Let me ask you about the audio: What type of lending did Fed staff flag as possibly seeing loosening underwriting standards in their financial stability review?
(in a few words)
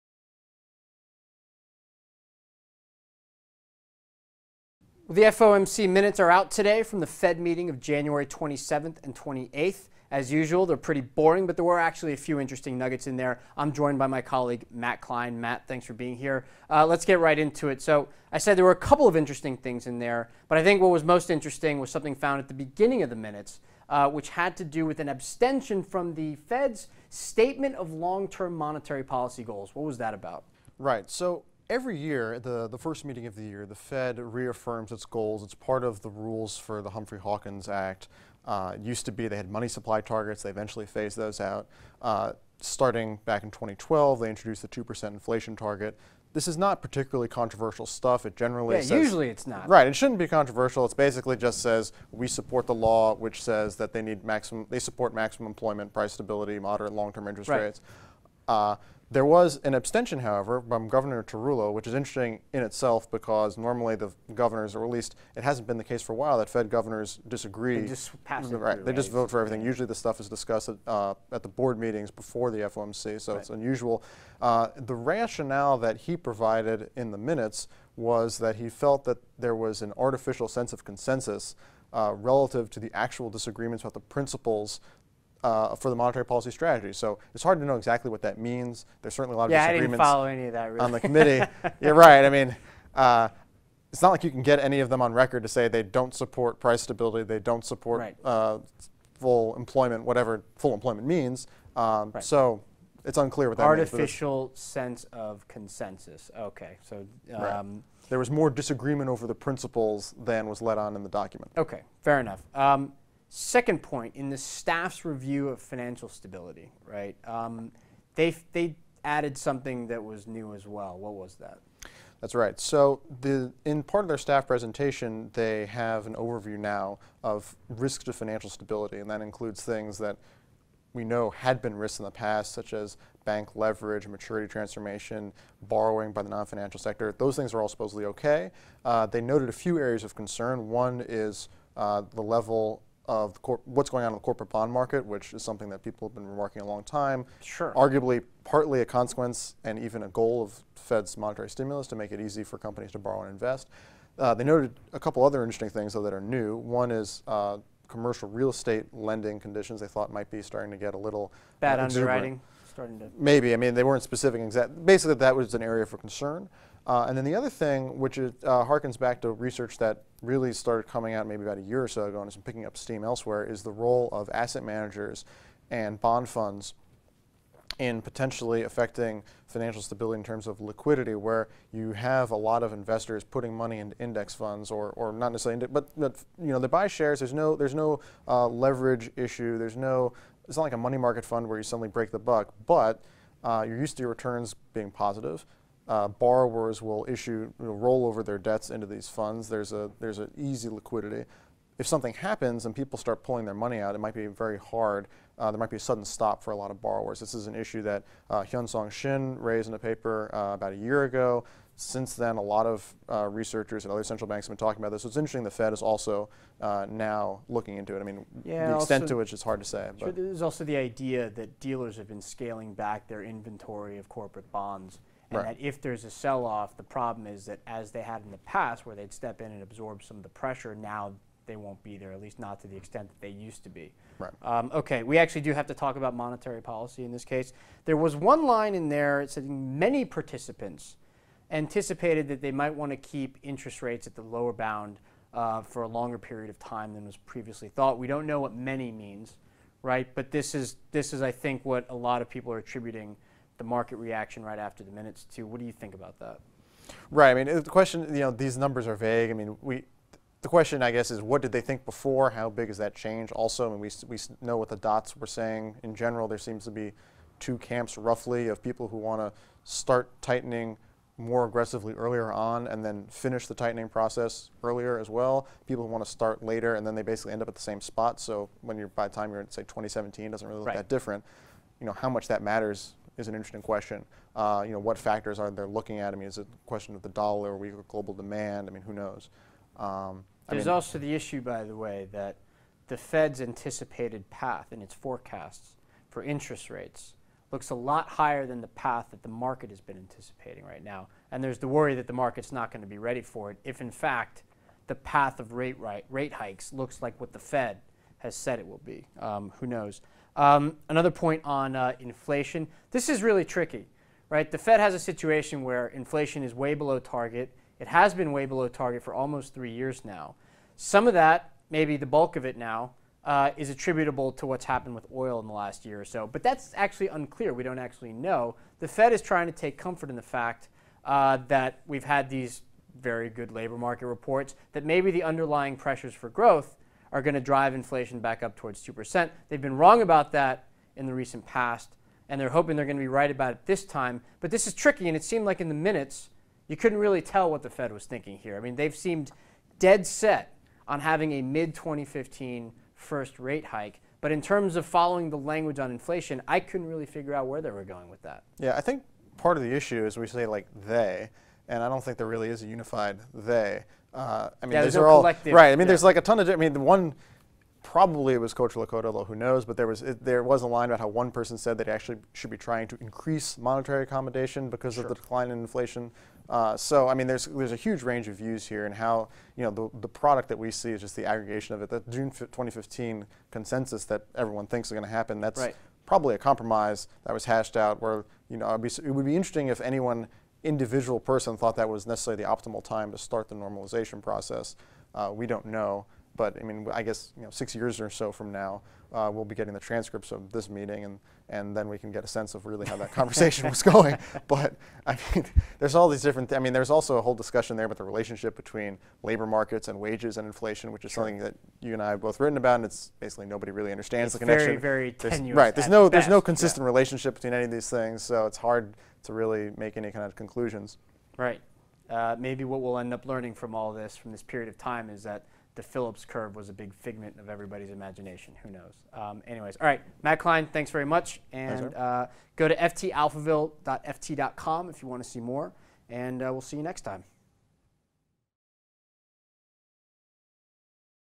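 Commercial real estate.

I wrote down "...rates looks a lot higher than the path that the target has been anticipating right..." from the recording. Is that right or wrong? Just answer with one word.
wrong.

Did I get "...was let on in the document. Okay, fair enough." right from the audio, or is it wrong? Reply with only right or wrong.
right.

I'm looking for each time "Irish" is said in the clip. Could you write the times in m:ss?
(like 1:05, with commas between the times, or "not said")
not said.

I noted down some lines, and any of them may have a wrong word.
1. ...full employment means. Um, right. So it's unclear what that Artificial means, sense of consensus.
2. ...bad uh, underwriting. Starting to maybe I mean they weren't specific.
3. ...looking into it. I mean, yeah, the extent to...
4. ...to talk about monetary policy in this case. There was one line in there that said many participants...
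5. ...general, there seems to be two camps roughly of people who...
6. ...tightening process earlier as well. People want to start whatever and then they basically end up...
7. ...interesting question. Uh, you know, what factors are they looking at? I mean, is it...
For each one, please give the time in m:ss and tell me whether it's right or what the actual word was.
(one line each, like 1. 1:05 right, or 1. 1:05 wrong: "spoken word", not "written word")
1. 1:40 right
2. 2:41 right
3. 3:37 right
4. 3:55 right
5. 4:25 right
6. 4:33 wrong: "later", not "whatever"
7. 4:43 right.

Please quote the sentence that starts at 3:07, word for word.
There's no there's no uh, leverage issue.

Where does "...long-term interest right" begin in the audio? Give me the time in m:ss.
0:56.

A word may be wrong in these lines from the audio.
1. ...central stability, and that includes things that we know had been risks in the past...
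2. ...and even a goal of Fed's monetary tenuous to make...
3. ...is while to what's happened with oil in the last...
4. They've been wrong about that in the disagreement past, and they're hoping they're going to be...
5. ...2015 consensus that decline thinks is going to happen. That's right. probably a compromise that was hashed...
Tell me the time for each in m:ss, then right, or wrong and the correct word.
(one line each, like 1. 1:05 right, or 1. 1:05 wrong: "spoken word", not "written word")
1. 2:08 wrong: "financial", not "central"
2. 2:29 wrong: "stimulus", not "tenuous"
3. 5:23 wrong: "attributable", not "while"
4. 5:39 wrong: "recent", not "disagreement"
5. 6:22 wrong: "everyone", not "decline".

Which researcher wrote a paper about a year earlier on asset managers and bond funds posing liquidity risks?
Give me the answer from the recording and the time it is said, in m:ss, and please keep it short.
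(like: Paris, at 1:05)
Hyun Song Shin, at 3:28.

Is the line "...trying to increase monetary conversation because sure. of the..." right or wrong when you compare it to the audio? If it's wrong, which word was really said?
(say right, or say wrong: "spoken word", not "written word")
wrong: "accommodation", not "conversation".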